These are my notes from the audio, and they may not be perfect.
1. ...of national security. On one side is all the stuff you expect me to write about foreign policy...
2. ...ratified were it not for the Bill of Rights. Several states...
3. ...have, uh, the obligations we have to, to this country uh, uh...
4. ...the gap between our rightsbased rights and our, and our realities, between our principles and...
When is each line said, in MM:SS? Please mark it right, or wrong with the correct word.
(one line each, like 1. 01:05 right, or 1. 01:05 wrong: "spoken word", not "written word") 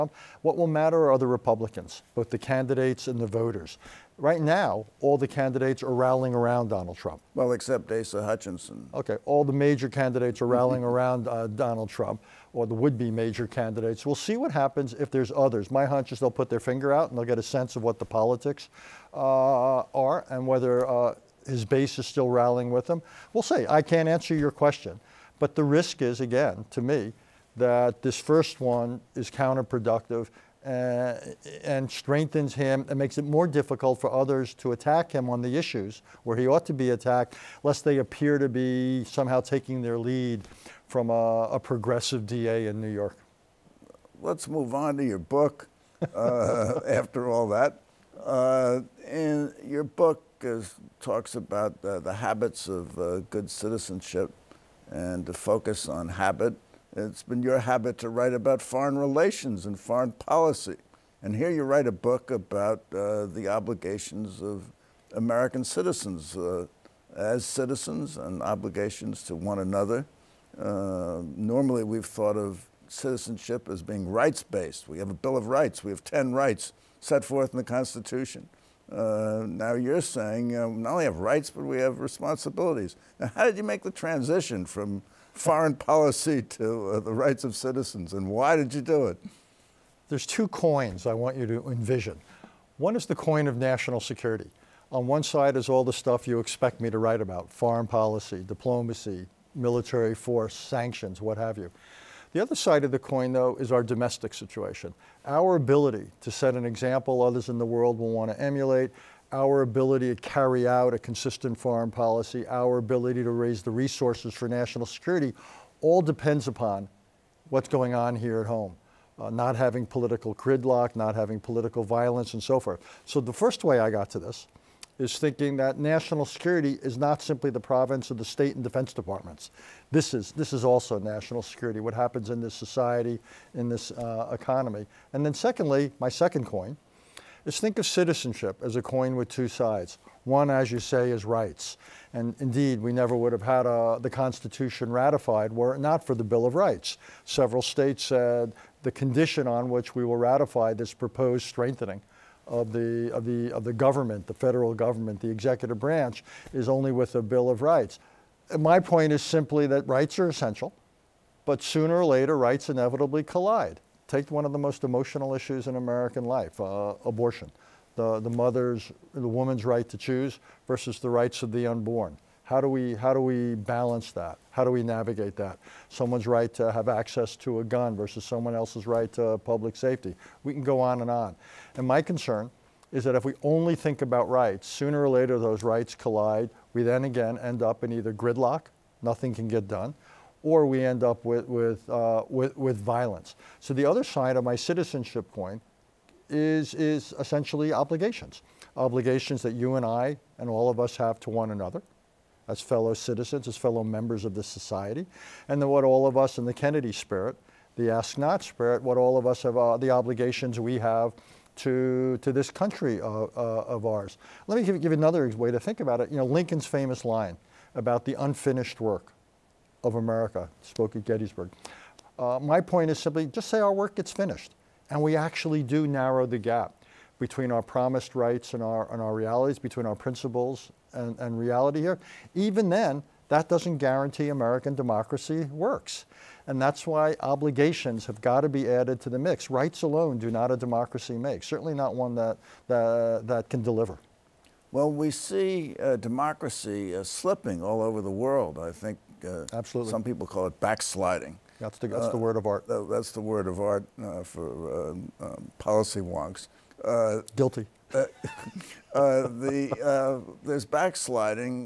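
1. 01:33 right
2. 02:24 right
3. 03:29 right
4. 03:46 wrong: "promised", not "rightsbased".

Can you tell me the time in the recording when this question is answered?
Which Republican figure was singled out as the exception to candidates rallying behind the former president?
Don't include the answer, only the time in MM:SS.
00:07.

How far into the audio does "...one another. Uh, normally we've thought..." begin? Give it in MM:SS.
01:09.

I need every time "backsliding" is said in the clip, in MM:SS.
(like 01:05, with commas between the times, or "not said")
04:10, 04:20.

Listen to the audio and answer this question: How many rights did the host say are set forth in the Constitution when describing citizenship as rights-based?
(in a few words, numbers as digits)
10.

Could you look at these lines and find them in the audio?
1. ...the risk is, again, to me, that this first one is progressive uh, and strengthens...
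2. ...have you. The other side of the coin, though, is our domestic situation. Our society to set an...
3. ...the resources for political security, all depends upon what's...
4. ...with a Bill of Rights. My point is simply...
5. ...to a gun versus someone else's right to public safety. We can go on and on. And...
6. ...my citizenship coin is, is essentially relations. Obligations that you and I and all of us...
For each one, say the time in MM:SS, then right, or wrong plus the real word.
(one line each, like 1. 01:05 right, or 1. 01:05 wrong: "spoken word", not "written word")
1. 00:25 wrong: "counterproductive", not "progressive"
2. 01:41 wrong: "ability", not "society"
3. 01:53 wrong: "national", not "political"
4. 02:36 right
5. 02:57 right
6. 03:14 wrong: "obligations", not "relations".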